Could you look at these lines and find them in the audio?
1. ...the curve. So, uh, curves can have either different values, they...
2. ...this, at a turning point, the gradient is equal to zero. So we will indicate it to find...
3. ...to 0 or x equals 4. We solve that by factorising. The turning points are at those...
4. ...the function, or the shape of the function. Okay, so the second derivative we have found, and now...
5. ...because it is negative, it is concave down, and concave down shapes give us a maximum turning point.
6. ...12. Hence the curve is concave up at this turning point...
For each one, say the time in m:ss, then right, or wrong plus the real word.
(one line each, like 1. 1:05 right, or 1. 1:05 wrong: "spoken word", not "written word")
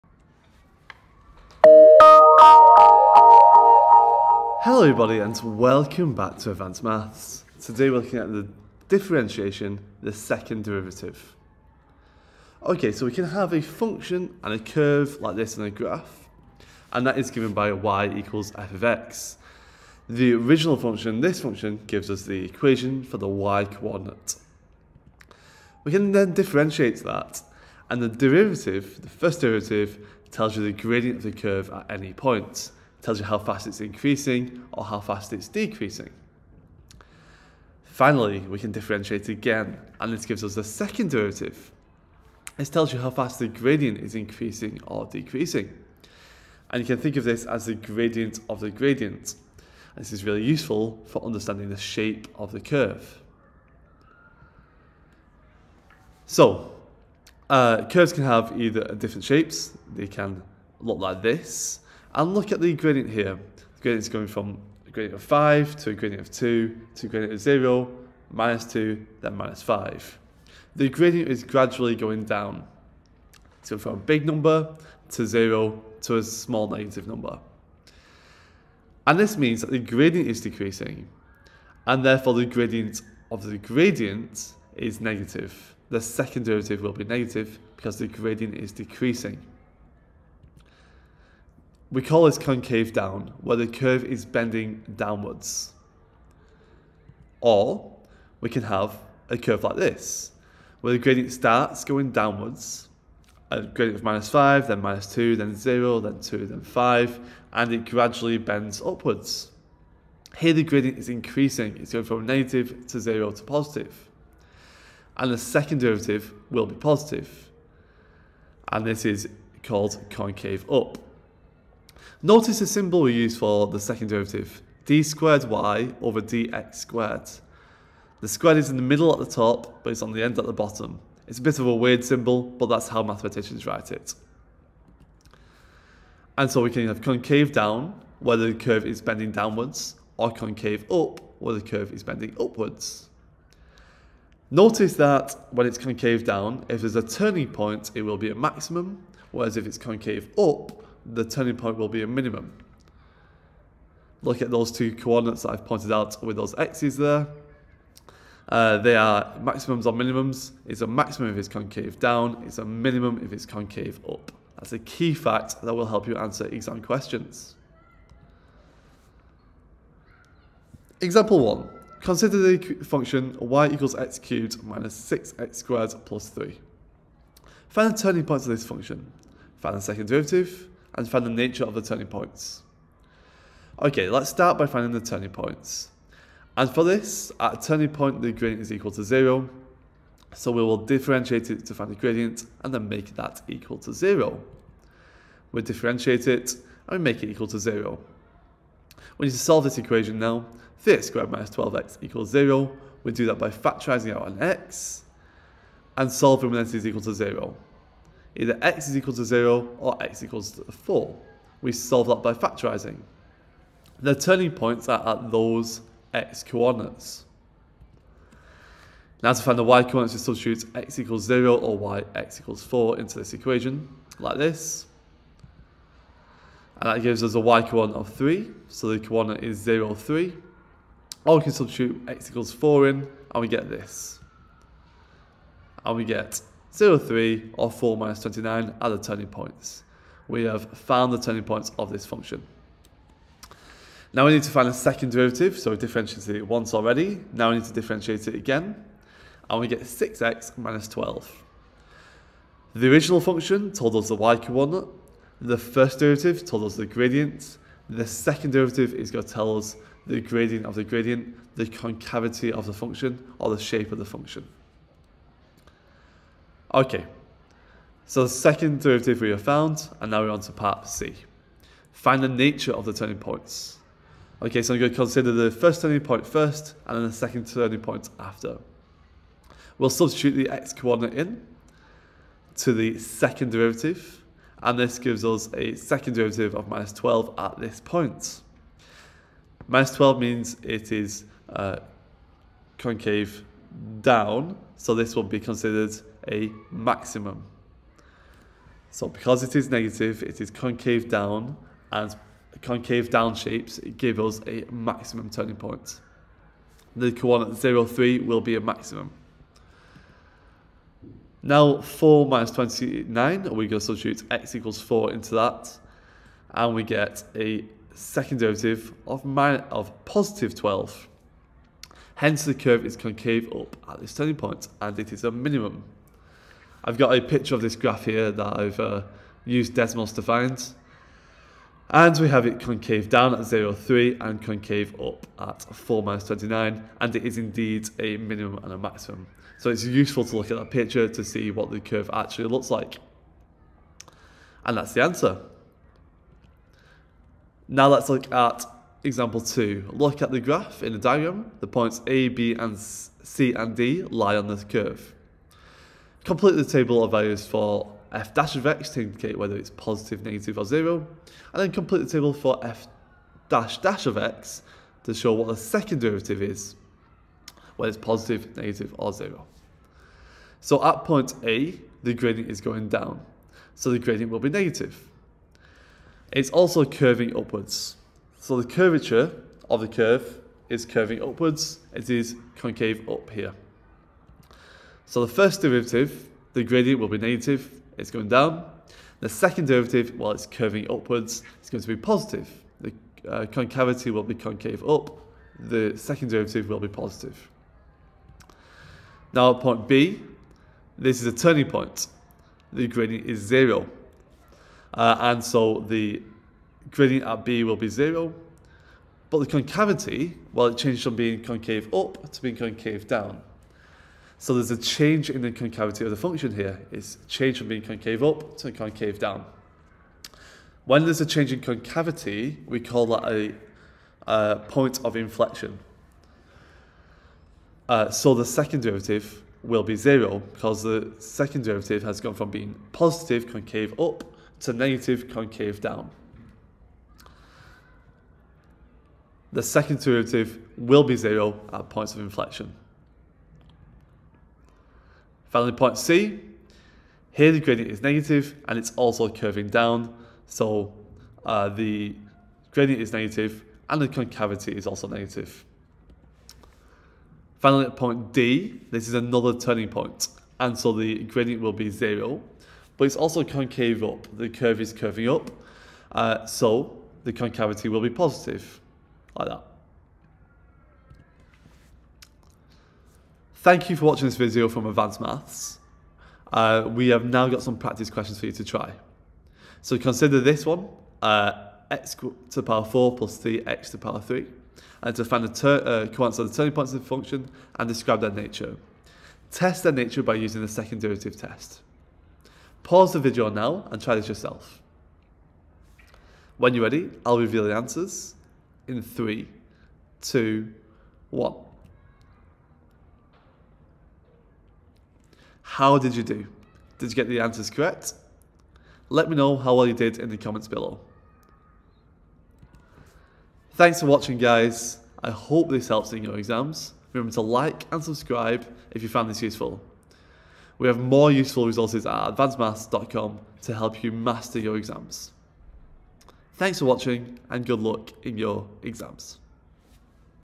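1. 0:52 wrong: "shapes", not "values"
2. 3:06 wrong: "differentiate", not "indicate"
3. 3:29 right
4. 4:22 right
5. 4:59 right
6. 5:20 right.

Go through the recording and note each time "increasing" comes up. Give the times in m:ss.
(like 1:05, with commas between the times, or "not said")
0:33, 0:44, 1:51.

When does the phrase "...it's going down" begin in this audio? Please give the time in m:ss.
6:27.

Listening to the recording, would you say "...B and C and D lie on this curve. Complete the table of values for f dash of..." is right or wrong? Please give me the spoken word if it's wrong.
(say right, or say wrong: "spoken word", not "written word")
right.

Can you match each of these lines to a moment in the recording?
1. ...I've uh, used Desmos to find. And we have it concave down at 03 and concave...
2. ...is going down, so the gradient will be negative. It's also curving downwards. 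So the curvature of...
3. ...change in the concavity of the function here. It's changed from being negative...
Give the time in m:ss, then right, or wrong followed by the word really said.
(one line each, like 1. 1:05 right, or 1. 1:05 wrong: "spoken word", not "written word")
1. 5:28 right
2. 6:12 wrong: "upwards", not "downwards"
3. 6:54 wrong: "concave", not "negative".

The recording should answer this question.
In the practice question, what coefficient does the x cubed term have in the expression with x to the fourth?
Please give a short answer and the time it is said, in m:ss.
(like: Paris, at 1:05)
3, at 8:03.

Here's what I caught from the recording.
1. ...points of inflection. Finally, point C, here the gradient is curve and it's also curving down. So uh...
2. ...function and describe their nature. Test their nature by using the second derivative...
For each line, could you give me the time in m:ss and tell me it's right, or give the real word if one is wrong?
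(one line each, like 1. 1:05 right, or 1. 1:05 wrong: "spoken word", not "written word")
1. 7:21 wrong: "negative", not "curve"
2. 8:07 right.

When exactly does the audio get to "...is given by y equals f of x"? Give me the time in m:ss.
0:17.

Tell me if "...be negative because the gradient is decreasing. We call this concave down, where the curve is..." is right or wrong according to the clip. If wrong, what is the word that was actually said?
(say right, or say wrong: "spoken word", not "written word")
right.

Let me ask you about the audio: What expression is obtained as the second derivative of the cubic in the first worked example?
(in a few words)
6x - 12.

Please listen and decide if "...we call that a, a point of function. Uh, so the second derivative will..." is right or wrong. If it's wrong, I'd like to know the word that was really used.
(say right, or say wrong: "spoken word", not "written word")
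wrong: "inflection", not "function".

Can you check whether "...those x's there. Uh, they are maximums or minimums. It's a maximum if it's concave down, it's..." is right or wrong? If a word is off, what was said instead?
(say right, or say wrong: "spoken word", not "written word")
right.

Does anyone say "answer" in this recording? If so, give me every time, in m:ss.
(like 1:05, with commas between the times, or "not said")
2:46, 5:45, 8:17, 8:27.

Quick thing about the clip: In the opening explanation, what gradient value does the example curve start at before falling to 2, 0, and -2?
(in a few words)
5.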